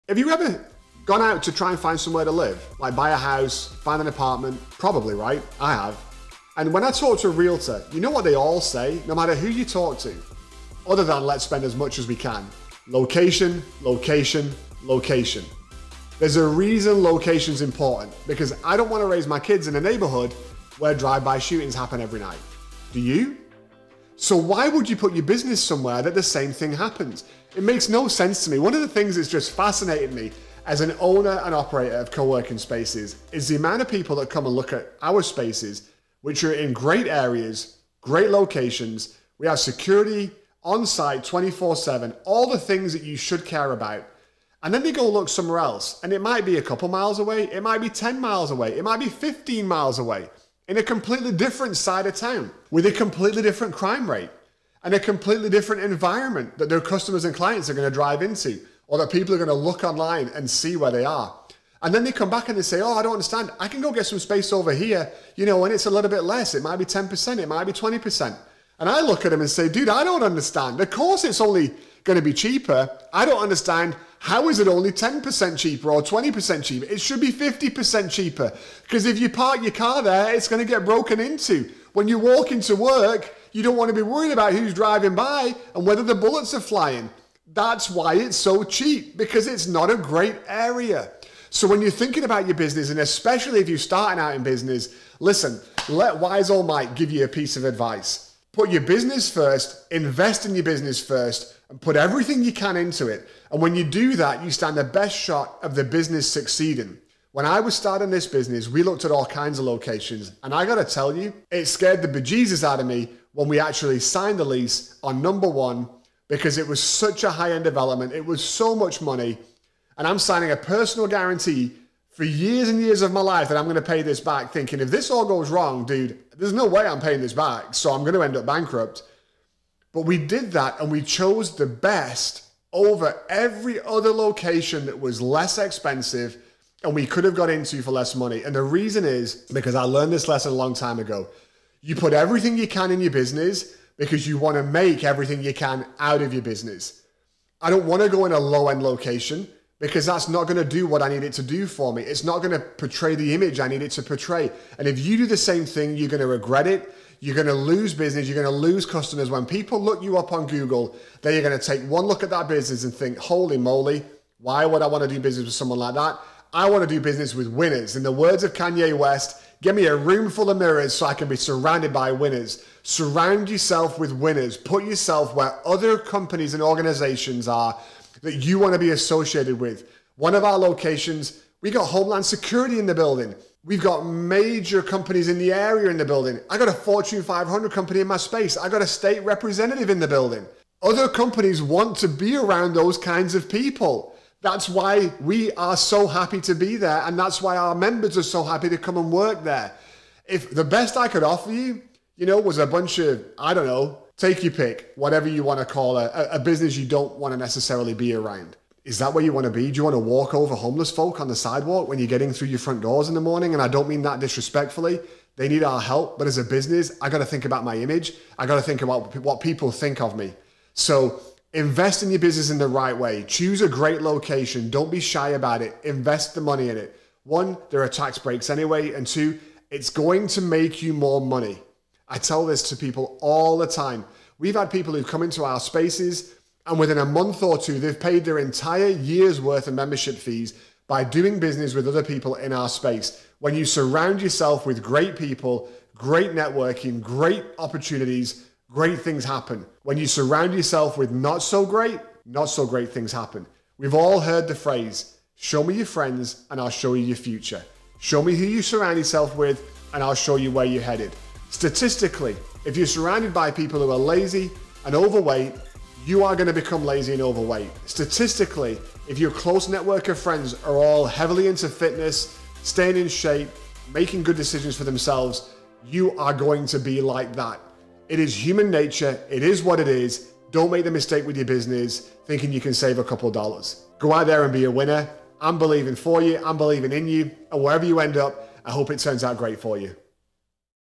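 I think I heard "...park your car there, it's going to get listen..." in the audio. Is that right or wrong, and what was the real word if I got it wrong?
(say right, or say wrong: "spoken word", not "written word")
wrong: "broken", not "listen".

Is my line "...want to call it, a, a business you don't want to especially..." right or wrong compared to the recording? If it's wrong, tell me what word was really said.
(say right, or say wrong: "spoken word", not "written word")
wrong: "necessarily", not "especially".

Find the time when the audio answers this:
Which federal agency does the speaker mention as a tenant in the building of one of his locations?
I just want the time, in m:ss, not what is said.
3:01.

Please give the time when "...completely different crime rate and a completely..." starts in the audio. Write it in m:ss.
0:52.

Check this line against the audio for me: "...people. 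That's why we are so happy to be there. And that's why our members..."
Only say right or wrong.
right.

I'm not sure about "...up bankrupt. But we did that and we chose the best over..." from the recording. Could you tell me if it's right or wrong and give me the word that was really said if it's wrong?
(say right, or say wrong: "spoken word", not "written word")
right.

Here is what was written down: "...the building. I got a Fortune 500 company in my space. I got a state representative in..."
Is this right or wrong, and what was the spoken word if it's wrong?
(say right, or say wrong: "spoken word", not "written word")
right.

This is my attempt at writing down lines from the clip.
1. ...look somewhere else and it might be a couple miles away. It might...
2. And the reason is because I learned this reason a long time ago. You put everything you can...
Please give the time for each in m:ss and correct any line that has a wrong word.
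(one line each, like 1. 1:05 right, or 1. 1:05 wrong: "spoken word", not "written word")
1. 0:45 right
2. 2:18 wrong: "lesson", not "reason".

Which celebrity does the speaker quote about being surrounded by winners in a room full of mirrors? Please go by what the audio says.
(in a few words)
Kanye West.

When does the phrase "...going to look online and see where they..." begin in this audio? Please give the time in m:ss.
0:59.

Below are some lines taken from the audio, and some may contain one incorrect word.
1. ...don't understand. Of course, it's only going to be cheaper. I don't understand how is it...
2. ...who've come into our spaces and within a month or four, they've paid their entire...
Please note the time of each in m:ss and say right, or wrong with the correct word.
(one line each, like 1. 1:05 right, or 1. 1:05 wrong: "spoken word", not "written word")
1. 1:10 right
2. 3:54 wrong: "two", not "four".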